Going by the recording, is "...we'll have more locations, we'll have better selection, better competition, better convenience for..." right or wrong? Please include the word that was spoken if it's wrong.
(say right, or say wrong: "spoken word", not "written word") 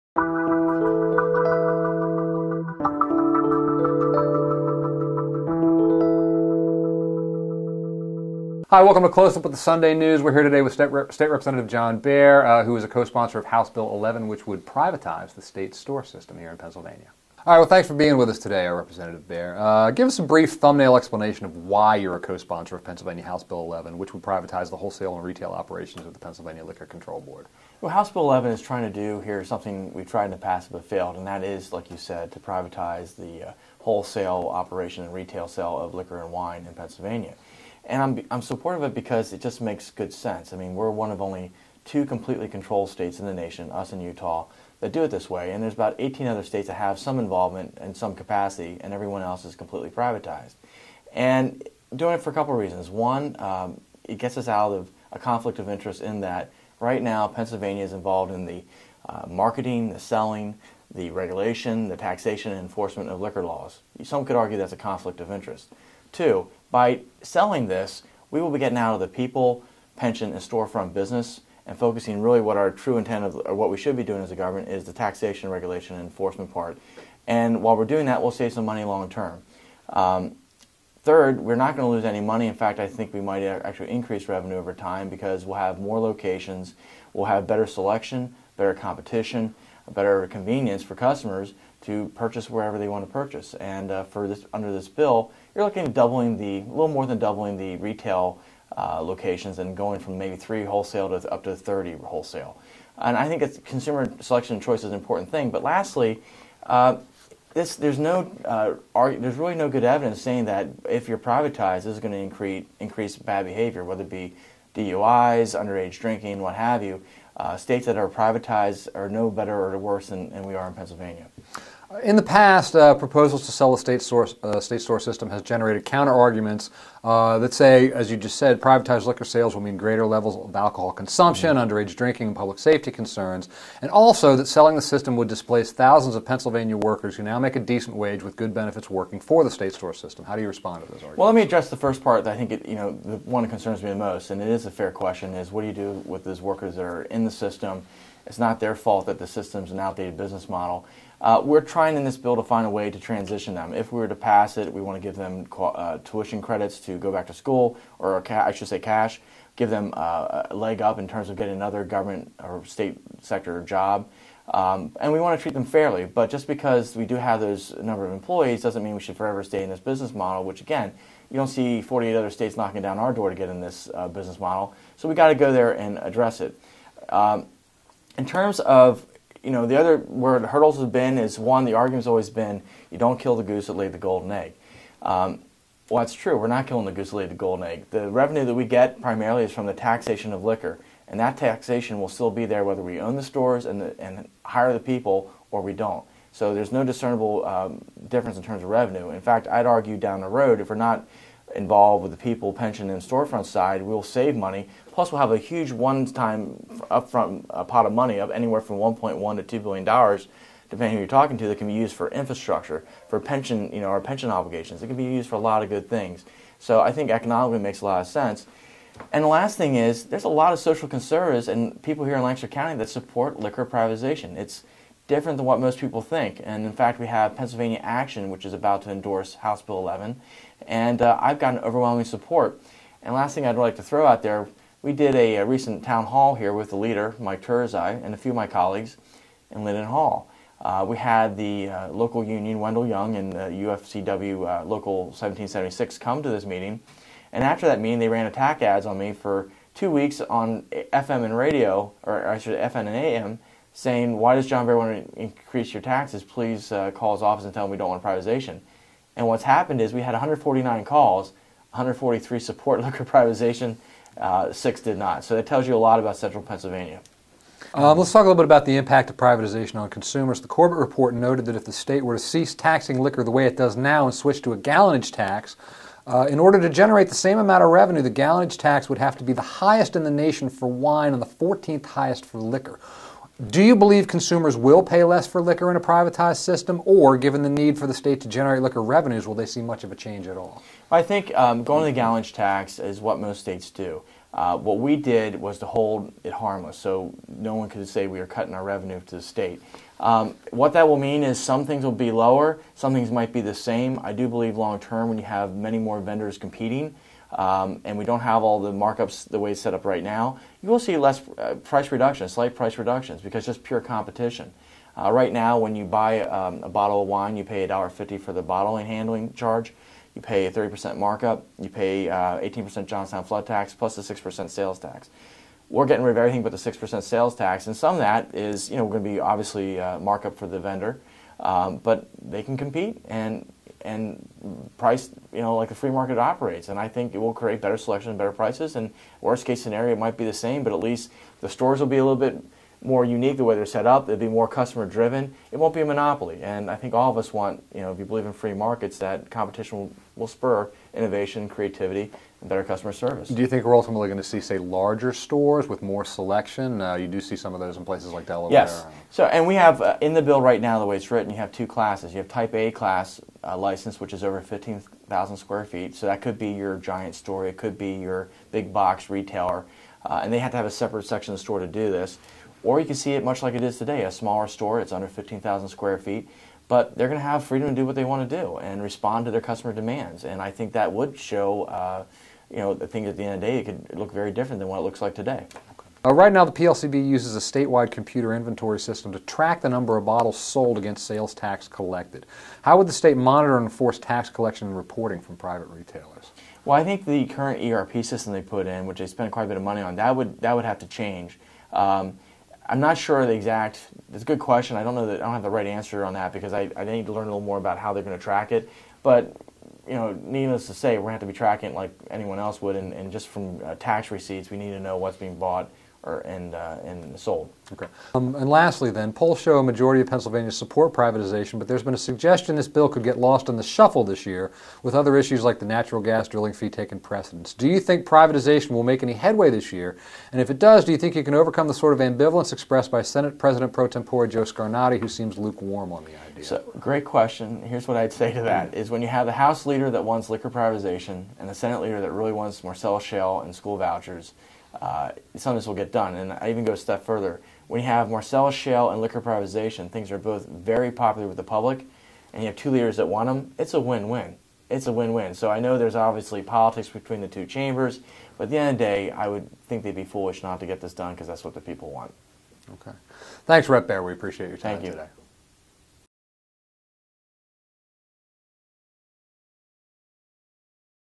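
right.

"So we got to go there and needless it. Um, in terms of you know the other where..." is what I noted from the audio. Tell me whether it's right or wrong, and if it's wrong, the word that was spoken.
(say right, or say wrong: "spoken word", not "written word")
wrong: "address", not "needless".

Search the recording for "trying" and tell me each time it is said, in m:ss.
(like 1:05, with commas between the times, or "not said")
0:28, 2:31.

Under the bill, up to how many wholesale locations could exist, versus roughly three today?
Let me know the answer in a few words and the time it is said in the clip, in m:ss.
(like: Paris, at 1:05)
30, at 1:41.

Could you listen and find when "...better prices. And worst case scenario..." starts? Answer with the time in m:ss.
5:38.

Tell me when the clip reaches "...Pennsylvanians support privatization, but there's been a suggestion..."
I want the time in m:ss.
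7:00.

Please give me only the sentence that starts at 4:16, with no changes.
Please uh, call his office and tell him we don't want privatization.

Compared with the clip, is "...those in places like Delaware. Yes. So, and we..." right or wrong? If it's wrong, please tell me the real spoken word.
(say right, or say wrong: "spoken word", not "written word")
right.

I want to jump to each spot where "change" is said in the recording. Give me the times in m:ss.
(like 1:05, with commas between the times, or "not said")
4:49, 6:40.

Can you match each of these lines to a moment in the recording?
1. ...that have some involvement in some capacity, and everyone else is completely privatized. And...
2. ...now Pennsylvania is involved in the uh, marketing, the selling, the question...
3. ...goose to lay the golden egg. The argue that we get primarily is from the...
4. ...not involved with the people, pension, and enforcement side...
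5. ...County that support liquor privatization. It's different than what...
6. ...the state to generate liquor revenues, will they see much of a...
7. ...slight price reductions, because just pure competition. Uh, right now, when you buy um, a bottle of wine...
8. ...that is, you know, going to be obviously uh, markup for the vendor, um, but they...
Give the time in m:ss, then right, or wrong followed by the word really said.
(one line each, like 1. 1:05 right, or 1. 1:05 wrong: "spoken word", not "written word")
1. 0:46 right
2. 0:57 wrong: "regulation", not "question"
3. 3:06 wrong: "revenue", not "argue"
4. 3:20 wrong: "storefront", not "enforcement"
5. 3:42 right
6. 4:47 right
7. 5:12 right
8. 5:27 right.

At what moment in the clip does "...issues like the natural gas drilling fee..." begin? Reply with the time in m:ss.
7:05.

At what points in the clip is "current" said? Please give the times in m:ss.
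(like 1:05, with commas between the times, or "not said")
6:37.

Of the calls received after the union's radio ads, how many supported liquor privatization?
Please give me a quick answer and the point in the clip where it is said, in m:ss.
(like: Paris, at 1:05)
143, at 4:21.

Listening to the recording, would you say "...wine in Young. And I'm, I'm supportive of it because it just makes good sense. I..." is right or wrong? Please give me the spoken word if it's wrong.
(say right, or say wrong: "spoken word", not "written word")
wrong: "Pennsylvania", not "Young".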